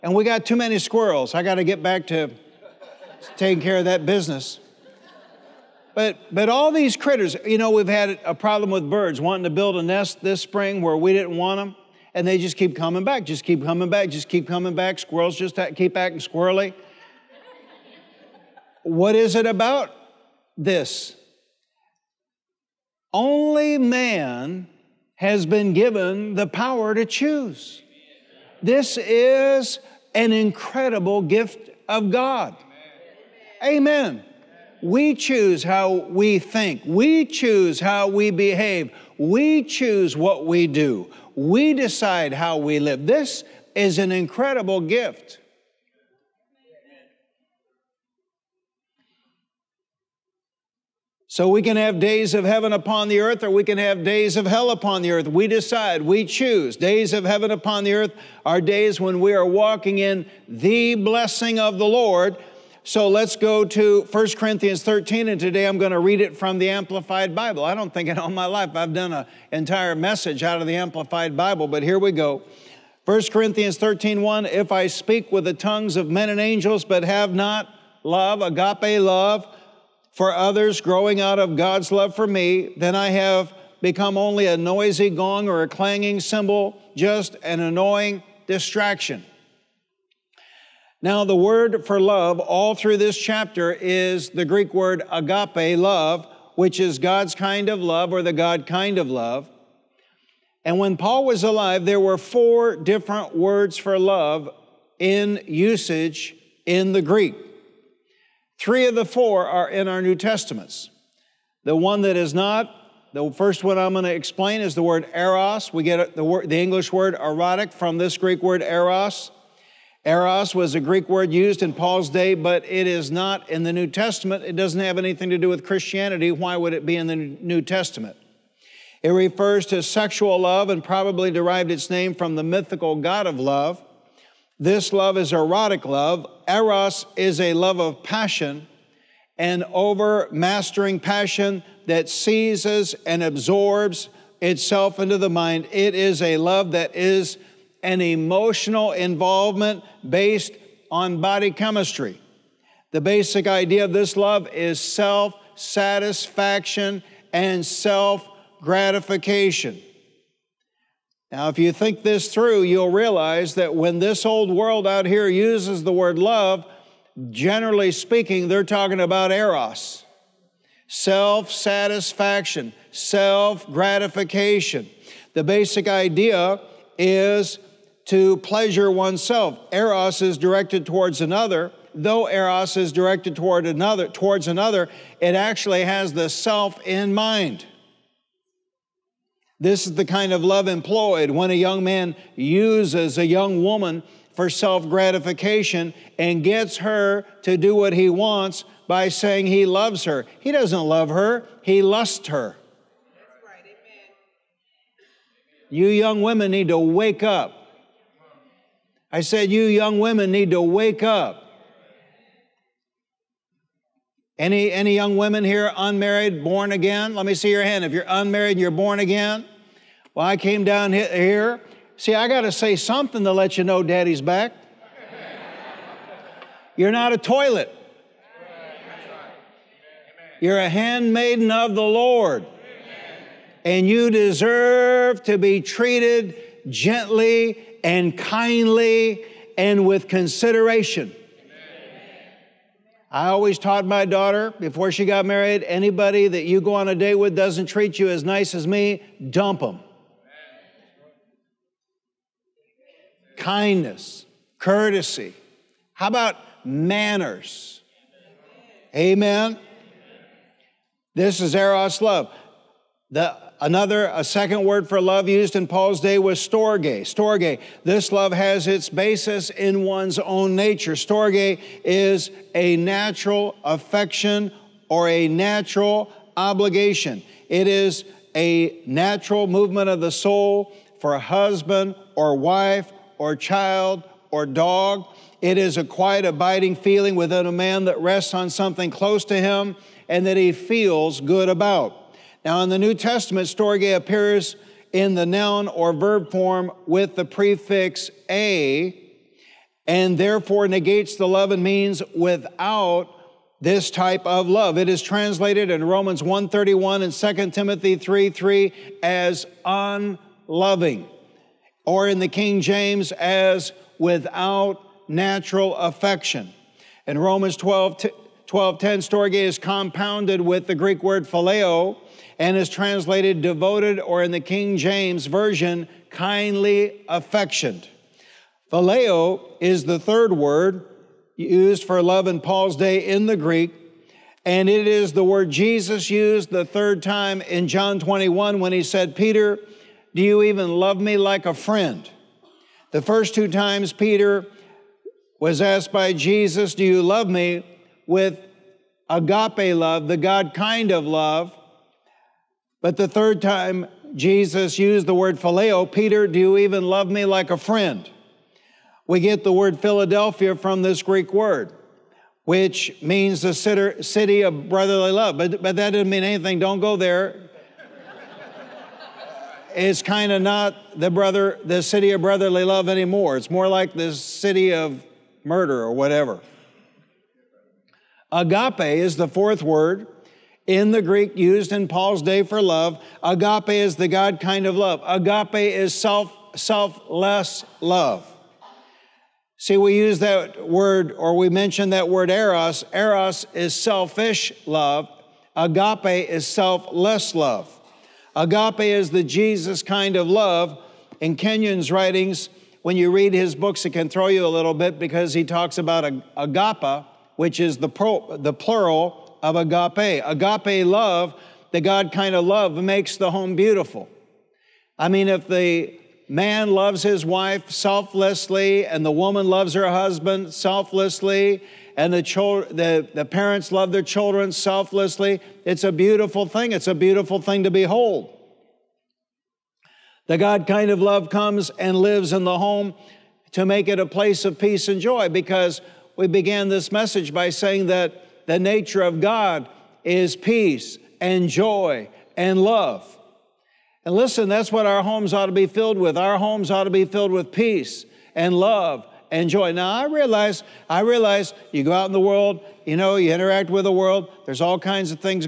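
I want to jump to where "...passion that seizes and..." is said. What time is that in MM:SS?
02:20.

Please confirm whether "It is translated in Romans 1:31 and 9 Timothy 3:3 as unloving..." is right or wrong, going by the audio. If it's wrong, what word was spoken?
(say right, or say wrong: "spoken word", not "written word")
wrong: "2", not "9".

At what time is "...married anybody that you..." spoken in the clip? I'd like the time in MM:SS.
04:05.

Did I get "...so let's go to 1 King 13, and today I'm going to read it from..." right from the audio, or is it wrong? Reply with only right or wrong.
wrong.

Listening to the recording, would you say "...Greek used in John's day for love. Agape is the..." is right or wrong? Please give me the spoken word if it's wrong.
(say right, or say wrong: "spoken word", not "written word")
wrong: "Paul", not "John".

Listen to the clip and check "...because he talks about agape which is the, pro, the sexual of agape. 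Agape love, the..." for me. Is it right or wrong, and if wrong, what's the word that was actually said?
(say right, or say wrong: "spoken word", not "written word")
wrong: "plural", not "sexual".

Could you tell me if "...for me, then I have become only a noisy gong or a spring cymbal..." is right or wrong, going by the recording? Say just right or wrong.
wrong.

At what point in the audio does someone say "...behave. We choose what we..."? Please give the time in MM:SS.
00:38.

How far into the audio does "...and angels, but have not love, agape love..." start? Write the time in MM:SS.
01:16.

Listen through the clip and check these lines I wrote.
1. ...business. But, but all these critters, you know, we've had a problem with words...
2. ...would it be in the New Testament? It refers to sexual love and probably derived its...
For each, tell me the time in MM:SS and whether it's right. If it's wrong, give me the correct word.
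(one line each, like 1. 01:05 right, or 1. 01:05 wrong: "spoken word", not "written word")
1. 00:04 wrong: "birds", not "words"
2. 02:06 right.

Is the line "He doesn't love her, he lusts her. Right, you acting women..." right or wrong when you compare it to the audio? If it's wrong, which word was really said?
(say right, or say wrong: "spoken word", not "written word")
wrong: "young", not "acting".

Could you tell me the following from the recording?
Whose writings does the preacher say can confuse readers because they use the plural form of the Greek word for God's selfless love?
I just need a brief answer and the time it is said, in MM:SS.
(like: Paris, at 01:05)
Kenyon, at 06:41.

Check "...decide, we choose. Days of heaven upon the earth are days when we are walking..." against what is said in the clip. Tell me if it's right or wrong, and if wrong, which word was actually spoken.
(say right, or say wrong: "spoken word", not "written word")
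right.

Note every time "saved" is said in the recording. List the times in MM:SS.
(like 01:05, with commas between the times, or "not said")
not said.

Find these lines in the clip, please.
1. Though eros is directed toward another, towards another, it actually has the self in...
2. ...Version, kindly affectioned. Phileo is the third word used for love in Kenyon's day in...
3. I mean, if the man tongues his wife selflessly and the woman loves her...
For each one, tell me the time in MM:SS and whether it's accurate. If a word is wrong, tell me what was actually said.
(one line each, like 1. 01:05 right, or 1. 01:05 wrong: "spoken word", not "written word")
1. 03:01 right
2. 05:25 wrong: "Paul", not "Kenyon"
3. 06:54 wrong: "loves", not "tongues".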